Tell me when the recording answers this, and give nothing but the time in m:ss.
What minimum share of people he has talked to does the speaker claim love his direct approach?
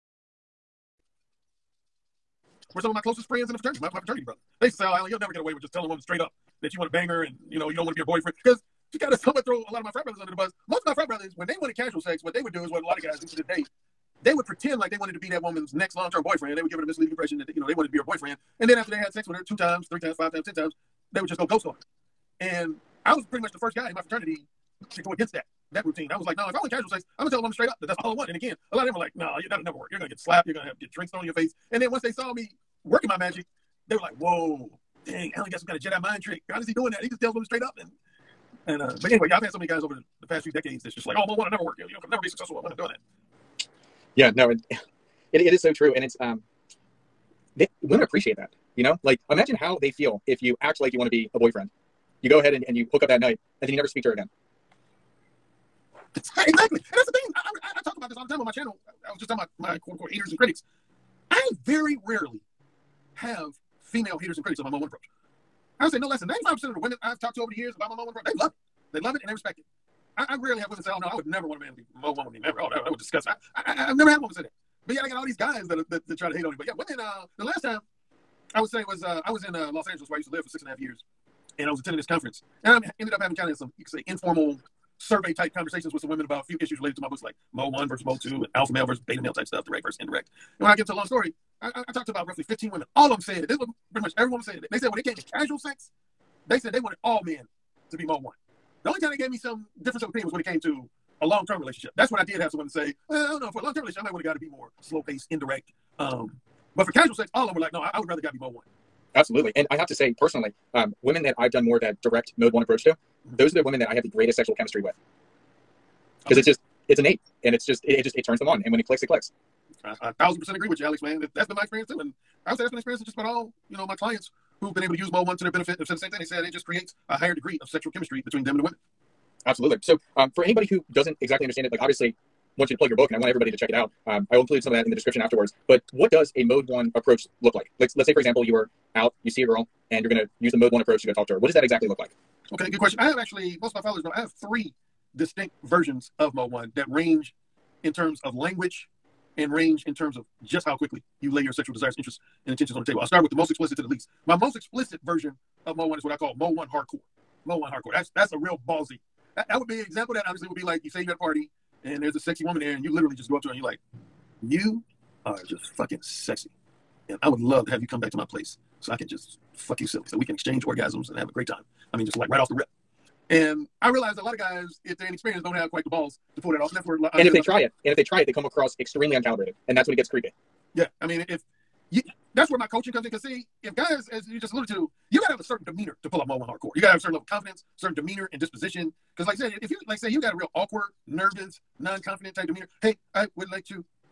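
1:06.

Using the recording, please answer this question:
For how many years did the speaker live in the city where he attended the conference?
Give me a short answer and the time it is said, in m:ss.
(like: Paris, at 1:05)
6.5 years, at 1:20.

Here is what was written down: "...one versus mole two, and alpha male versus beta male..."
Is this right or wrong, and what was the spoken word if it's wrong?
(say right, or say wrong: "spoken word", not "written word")
right.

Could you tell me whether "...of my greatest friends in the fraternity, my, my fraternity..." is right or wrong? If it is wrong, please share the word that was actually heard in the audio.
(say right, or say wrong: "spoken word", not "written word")
wrong: "closest", not "greatest".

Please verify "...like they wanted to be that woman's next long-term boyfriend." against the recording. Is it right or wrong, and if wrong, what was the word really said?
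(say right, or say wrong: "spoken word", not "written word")
right.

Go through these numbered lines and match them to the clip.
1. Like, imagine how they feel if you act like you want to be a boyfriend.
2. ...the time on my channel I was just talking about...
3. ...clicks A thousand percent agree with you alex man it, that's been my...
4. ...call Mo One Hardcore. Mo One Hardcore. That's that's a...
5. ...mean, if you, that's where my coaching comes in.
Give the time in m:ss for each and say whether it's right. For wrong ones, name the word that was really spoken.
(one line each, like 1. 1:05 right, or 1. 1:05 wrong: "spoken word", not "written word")
1. 0:49 right
2. 0:58 right
3. 1:59 right
4. 2:36 right
5. 3:01 right.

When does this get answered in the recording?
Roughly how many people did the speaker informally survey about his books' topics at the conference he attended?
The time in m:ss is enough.
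1:32.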